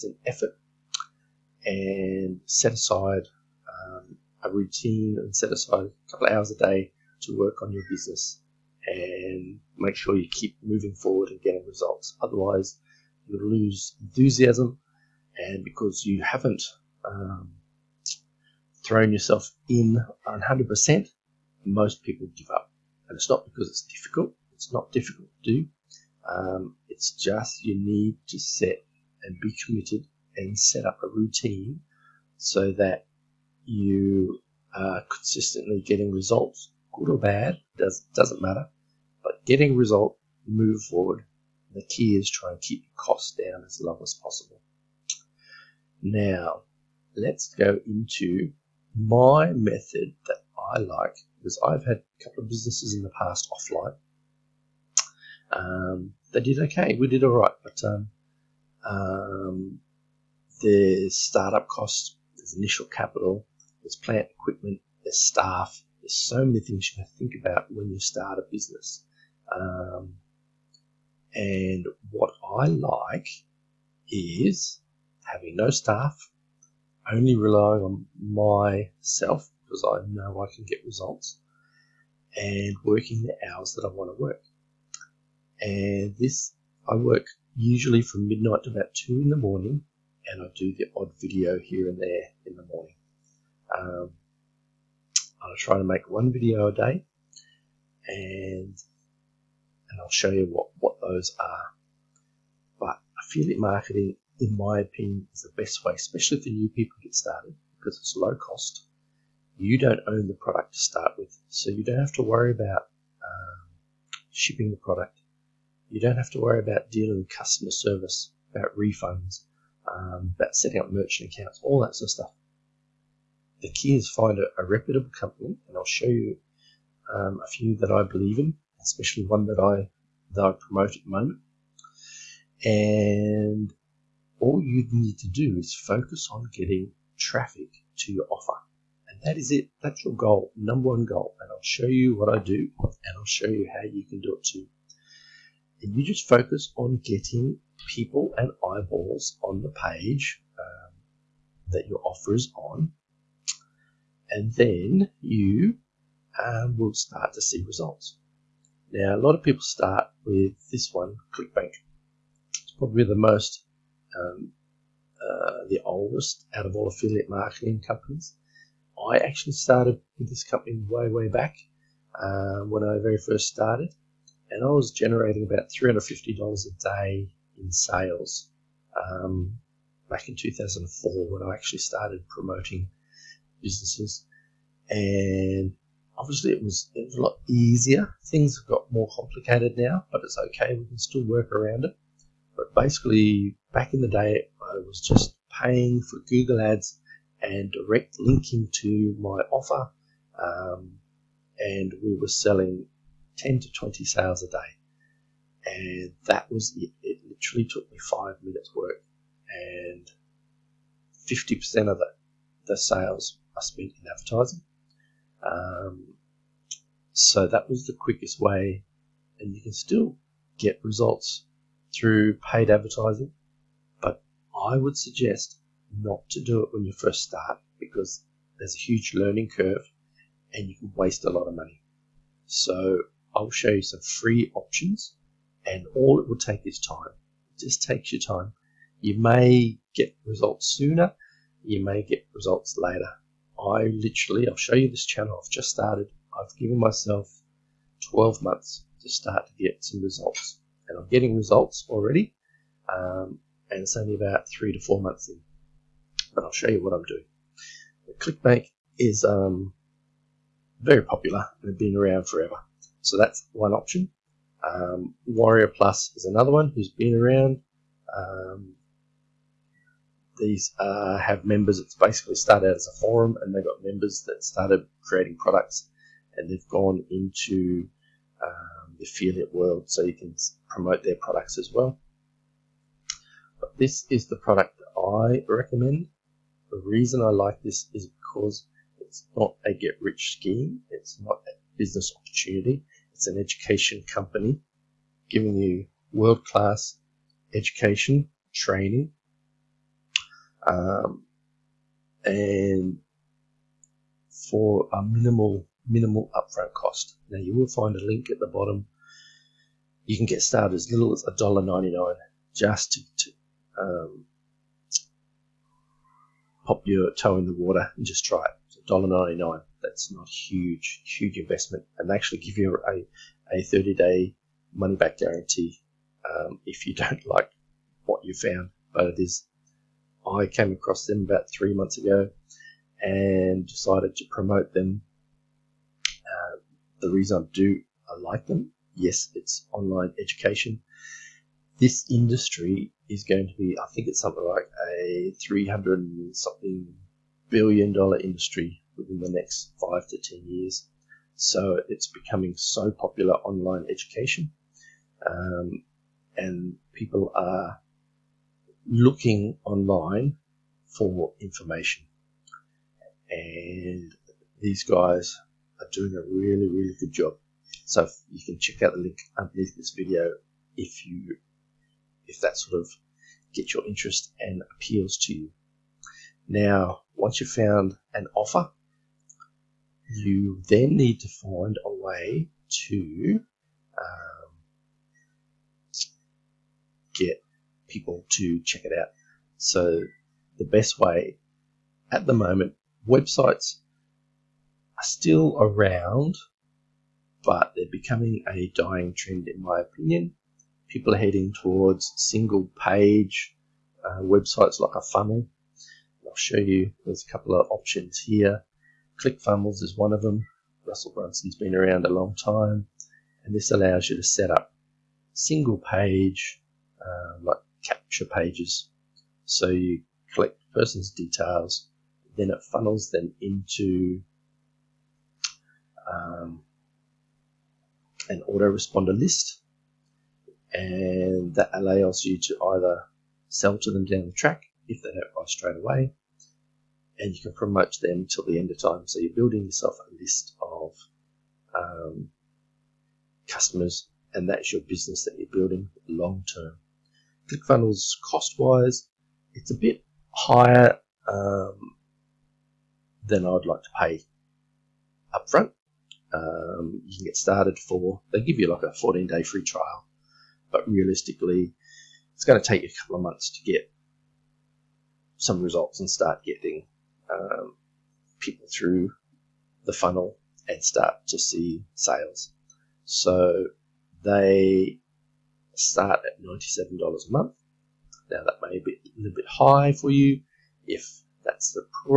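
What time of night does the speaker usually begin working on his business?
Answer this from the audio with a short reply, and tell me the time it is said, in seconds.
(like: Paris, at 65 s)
Midnight, at 88 s.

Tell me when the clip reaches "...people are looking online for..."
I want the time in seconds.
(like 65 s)
356 s.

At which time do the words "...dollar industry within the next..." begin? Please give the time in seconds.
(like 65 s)
347 s.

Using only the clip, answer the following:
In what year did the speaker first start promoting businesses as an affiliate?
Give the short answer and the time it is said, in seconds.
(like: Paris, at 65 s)
2004, at 180 s.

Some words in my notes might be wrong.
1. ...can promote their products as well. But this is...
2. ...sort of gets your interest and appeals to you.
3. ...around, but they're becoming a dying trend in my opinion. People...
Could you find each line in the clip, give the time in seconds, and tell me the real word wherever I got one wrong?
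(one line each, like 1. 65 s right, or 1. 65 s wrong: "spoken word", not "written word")
1. 280 s right
2. 372 s right
3. 395 s right.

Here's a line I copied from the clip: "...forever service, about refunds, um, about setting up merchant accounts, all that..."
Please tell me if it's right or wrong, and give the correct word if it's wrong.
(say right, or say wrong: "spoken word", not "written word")
wrong: "customer", not "forever".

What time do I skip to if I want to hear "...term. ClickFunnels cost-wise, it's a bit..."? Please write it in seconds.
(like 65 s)
446 s.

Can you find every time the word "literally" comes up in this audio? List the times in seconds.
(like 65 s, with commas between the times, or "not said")
207 s, 243 s.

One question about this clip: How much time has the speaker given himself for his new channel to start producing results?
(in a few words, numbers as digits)
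12 months.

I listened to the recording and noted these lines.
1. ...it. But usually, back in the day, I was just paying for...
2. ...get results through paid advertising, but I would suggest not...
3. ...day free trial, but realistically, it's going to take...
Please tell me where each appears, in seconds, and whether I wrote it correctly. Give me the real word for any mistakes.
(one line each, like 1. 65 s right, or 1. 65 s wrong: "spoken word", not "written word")
1. 191 s wrong: "basically", not "usually"
2. 220 s right
3. 459 s right.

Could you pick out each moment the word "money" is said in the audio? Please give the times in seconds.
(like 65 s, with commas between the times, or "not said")
231 s, 324 s.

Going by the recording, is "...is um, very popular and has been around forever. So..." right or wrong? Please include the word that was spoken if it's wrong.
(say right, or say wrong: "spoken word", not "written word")
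right.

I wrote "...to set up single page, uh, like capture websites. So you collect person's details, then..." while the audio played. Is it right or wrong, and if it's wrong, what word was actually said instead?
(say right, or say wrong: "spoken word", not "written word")
wrong: "pages", not "websites".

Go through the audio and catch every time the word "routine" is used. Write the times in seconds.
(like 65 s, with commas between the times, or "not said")
4 s, 31 s.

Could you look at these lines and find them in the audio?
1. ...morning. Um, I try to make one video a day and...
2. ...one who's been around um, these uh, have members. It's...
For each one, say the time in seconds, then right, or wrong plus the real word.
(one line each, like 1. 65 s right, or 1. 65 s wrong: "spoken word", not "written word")
1. 92 s right
2. 266 s right.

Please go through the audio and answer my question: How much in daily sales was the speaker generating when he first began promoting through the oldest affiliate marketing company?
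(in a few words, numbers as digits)
$350.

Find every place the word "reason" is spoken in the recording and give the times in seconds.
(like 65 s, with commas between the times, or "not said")
286 s, 337 s.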